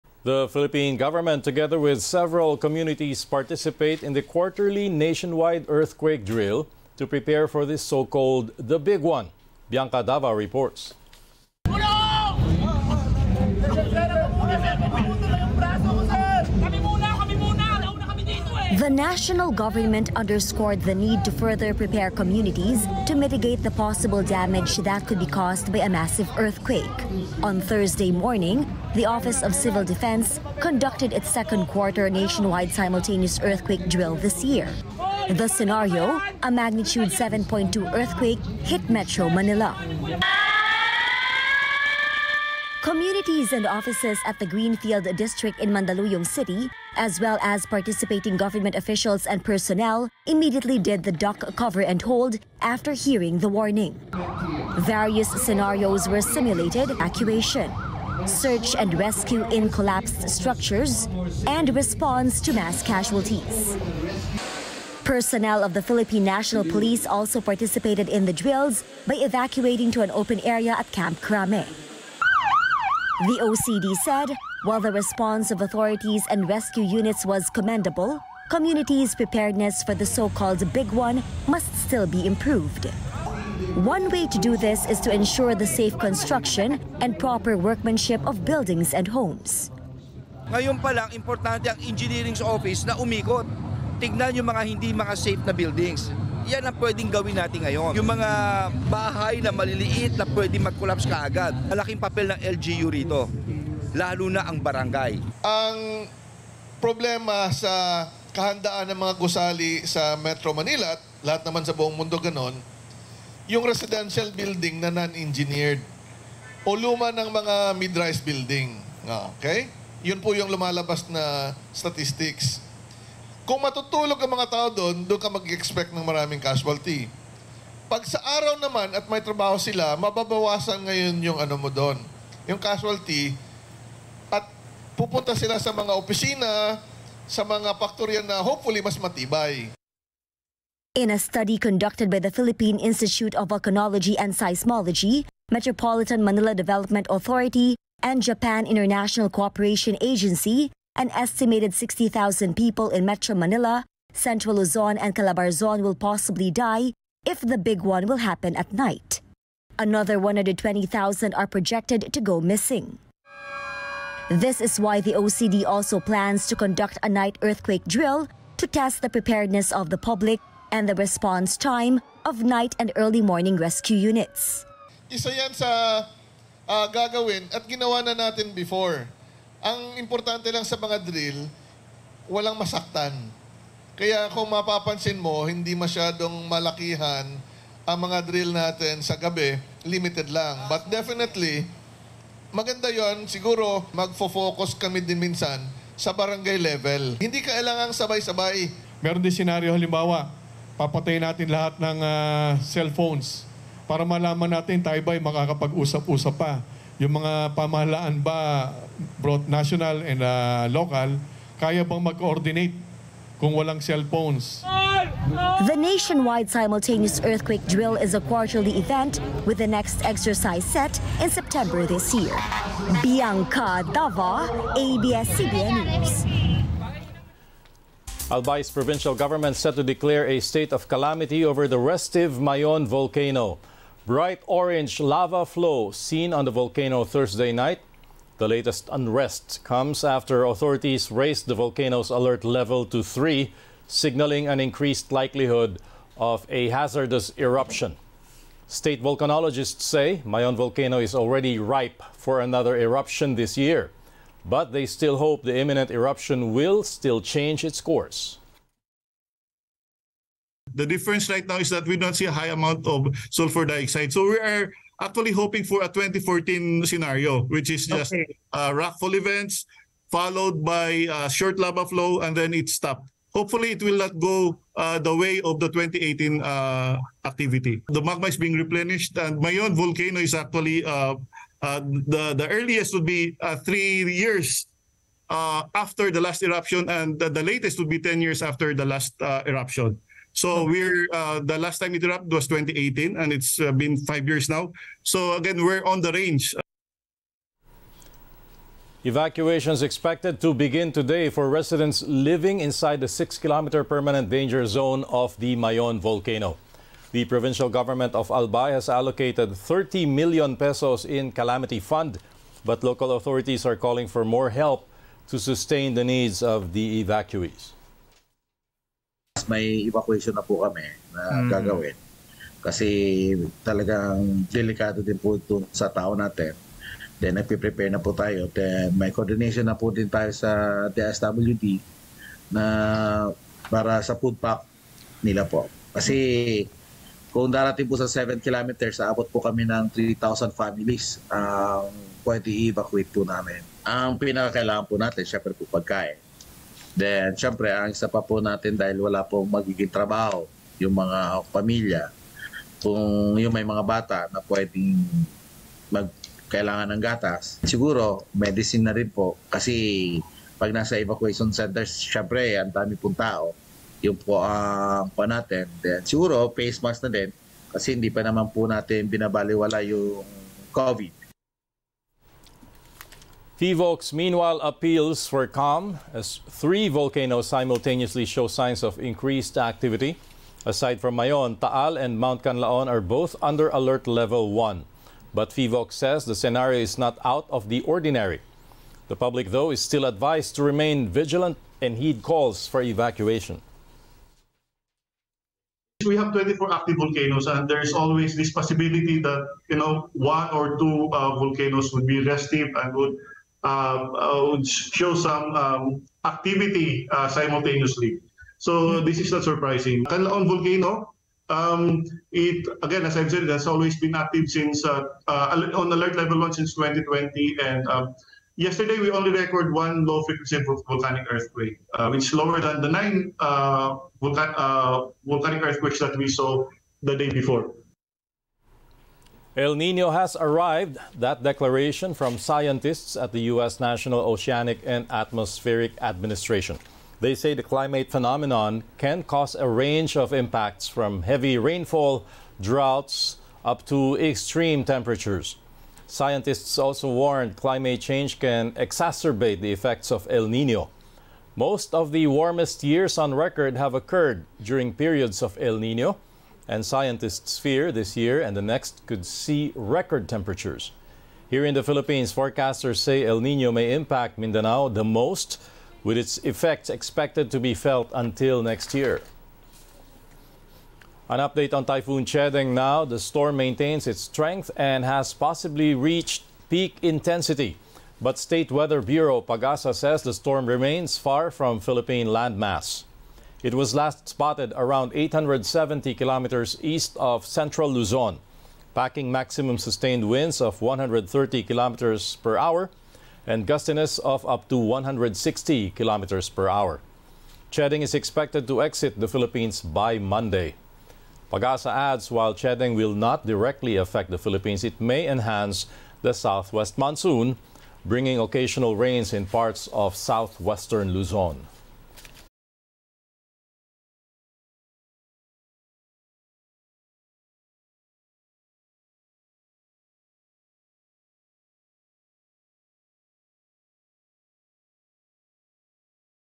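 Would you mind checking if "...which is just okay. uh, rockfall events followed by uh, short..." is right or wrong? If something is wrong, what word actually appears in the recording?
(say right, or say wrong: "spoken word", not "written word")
right.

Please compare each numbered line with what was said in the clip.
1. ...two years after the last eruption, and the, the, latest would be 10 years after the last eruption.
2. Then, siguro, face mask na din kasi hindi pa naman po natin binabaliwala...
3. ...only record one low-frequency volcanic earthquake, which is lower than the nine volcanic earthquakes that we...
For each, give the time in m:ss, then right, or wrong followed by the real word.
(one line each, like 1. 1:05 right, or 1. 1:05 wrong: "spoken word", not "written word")
1. 4:43 wrong: "three", not "two"
2. 6:05 right
3. 6:59 right.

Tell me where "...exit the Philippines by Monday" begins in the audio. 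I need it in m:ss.
8:18.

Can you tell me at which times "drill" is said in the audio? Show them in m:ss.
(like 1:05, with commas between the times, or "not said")
0:06, 0:33, 1:08, 2:47, 3:01, 3:08, 3:37.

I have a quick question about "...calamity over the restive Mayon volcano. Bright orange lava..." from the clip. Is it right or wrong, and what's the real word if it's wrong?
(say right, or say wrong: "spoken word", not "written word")
right.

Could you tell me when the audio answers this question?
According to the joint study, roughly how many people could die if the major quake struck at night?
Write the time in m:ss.
2:31.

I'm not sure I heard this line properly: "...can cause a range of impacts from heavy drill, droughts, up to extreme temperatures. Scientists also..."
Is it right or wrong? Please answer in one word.
wrong.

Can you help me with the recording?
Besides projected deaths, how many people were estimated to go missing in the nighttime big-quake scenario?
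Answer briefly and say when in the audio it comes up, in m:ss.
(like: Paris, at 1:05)
120,000, at 2:40.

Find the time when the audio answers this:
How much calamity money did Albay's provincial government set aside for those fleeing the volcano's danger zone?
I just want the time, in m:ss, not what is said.
5:09.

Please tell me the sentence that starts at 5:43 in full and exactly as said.
Ang pinakakailangan po natin, syempre po pagkain.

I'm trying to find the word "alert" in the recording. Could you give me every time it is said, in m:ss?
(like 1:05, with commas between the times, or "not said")
4:02, 6:23, 6:55.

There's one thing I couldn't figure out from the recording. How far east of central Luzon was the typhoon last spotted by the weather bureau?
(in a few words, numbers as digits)
870 kilometers.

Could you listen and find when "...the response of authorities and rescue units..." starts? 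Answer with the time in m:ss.
1:14.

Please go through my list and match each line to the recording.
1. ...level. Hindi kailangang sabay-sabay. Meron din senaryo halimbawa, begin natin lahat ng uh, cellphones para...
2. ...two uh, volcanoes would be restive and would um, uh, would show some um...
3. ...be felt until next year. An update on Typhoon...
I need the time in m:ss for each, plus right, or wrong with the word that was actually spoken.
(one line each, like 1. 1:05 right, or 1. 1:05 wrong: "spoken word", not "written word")
1. 3:16 wrong: "papatayin", not "begin"
2. 6:40 right
3. 7:47 right.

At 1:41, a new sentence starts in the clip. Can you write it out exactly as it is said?
Malaking papel ng LGU rito, lalo na ang barangay.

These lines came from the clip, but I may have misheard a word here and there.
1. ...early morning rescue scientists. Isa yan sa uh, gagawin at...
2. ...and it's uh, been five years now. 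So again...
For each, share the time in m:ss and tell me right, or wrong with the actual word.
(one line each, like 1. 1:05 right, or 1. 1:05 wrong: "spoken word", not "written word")
1. 2:52 wrong: "units", not "scientists"
2. 4:53 right.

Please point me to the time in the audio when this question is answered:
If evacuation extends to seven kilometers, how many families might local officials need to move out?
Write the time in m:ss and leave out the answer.
5:40.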